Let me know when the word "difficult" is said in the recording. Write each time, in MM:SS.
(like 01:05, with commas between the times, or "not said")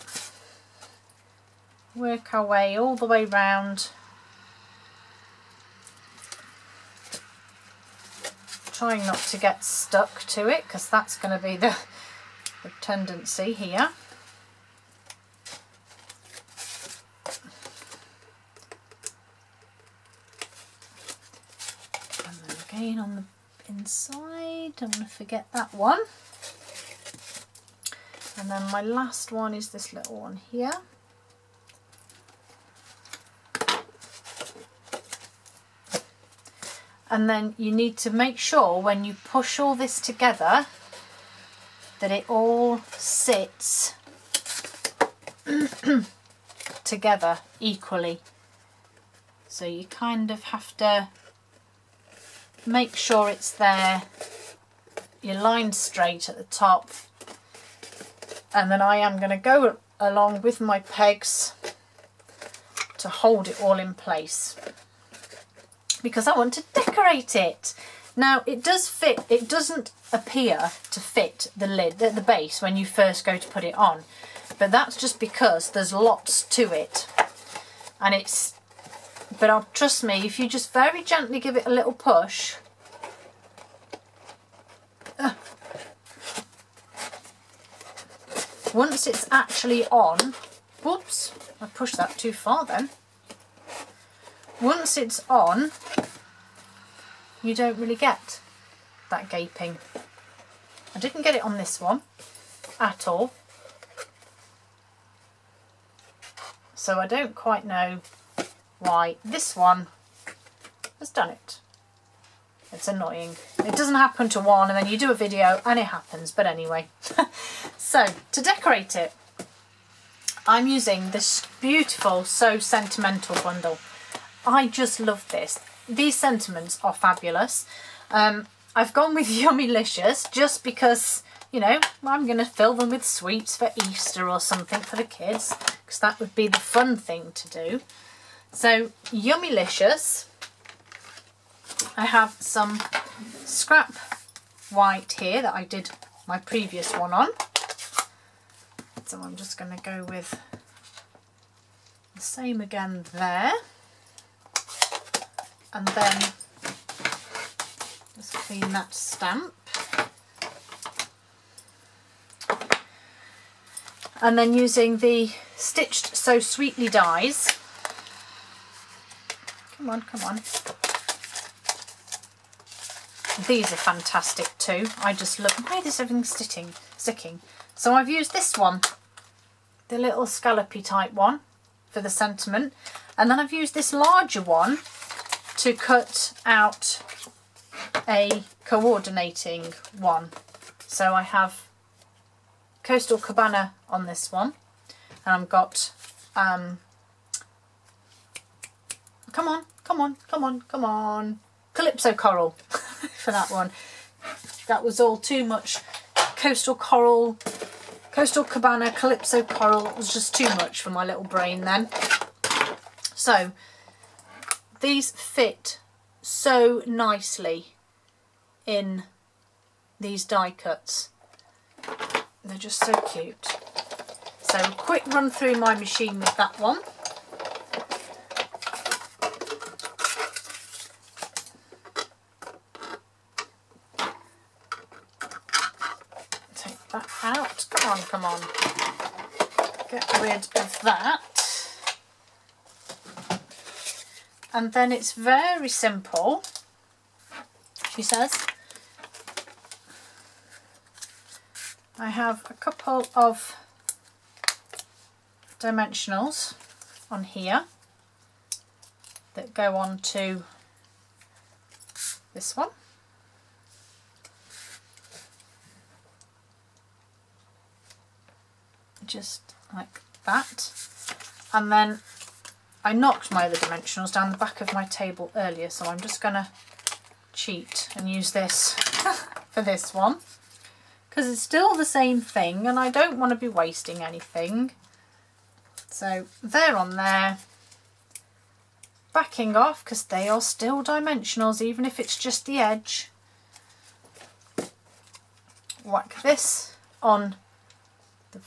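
not said.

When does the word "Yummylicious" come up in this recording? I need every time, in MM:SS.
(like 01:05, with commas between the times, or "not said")
02:09, 02:19.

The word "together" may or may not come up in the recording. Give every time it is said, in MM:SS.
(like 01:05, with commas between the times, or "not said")
00:40, 00:46.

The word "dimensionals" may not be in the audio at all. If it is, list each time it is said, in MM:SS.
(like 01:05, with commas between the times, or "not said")
04:15, 04:33, 04:50.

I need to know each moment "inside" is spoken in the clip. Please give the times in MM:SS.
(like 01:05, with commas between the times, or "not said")
00:23.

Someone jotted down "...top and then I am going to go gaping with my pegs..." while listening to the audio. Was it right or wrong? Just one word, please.
wrong.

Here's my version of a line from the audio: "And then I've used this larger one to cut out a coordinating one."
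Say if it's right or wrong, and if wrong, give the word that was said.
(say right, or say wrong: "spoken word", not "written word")
right.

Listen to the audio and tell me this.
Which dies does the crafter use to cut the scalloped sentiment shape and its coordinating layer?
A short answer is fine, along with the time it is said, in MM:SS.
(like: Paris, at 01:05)
Stitched So Sweetly, at 02:45.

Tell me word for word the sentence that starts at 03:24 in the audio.
That was all too much Coastal Coral, Coastal Cabana, Calypso Coral, it was just too much for my little brain then.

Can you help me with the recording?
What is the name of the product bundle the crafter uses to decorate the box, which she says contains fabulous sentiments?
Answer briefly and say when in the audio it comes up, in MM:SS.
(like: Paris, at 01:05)
So Sentimental, at 02:02.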